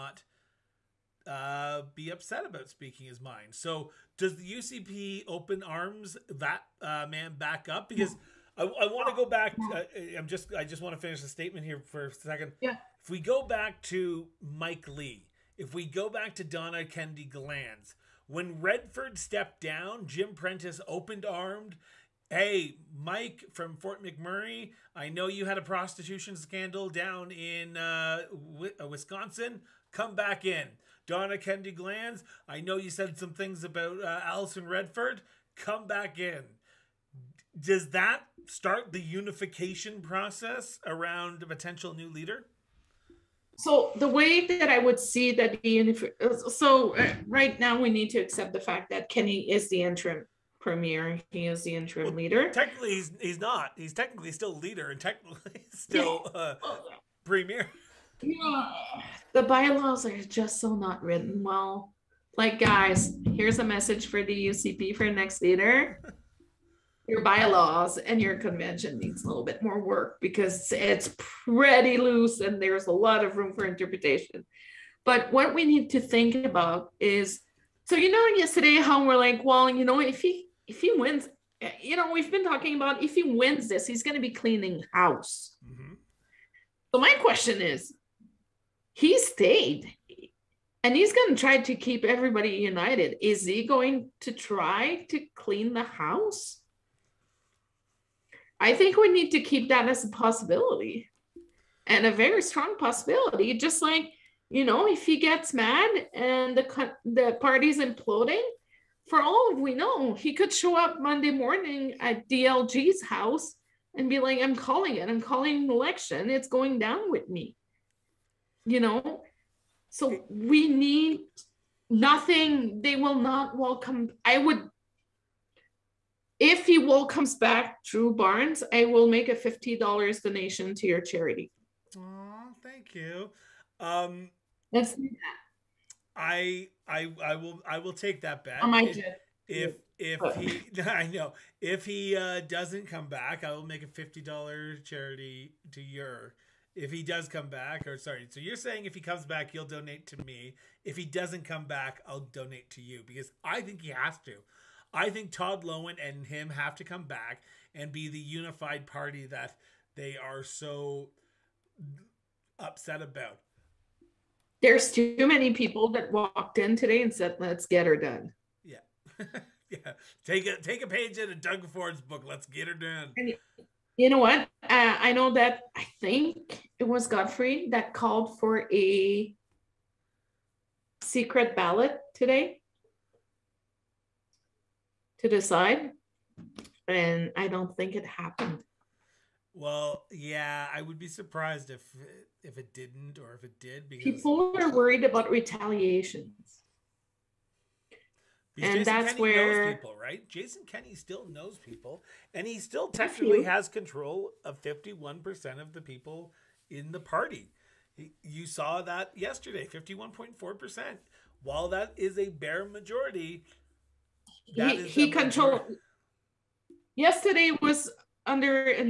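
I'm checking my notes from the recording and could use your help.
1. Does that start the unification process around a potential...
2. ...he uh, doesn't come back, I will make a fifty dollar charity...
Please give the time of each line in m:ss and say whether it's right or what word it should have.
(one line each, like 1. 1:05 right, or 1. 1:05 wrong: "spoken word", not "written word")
1. 0:37 right
2. 2:21 right.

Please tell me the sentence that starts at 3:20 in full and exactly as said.
Jason Kenney still knows people, and he still technically has control of fifty-one percent of the people in the party.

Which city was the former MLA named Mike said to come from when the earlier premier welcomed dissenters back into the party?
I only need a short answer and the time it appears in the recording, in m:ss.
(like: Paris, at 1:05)
Fort McMurray, at 0:23.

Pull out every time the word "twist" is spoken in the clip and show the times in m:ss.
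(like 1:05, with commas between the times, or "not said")
not said.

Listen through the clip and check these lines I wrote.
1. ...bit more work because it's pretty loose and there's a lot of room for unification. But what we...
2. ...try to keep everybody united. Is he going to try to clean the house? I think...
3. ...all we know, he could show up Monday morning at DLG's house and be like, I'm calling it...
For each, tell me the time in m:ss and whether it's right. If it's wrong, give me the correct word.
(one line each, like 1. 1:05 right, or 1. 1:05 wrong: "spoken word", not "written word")
1. 1:09 wrong: "interpretation", not "unification"
2. 1:31 right
3. 1:49 right.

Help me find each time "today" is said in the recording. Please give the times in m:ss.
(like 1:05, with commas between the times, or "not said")
2:46, 3:02.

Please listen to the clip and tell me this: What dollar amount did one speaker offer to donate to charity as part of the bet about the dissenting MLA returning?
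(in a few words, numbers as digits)
$50.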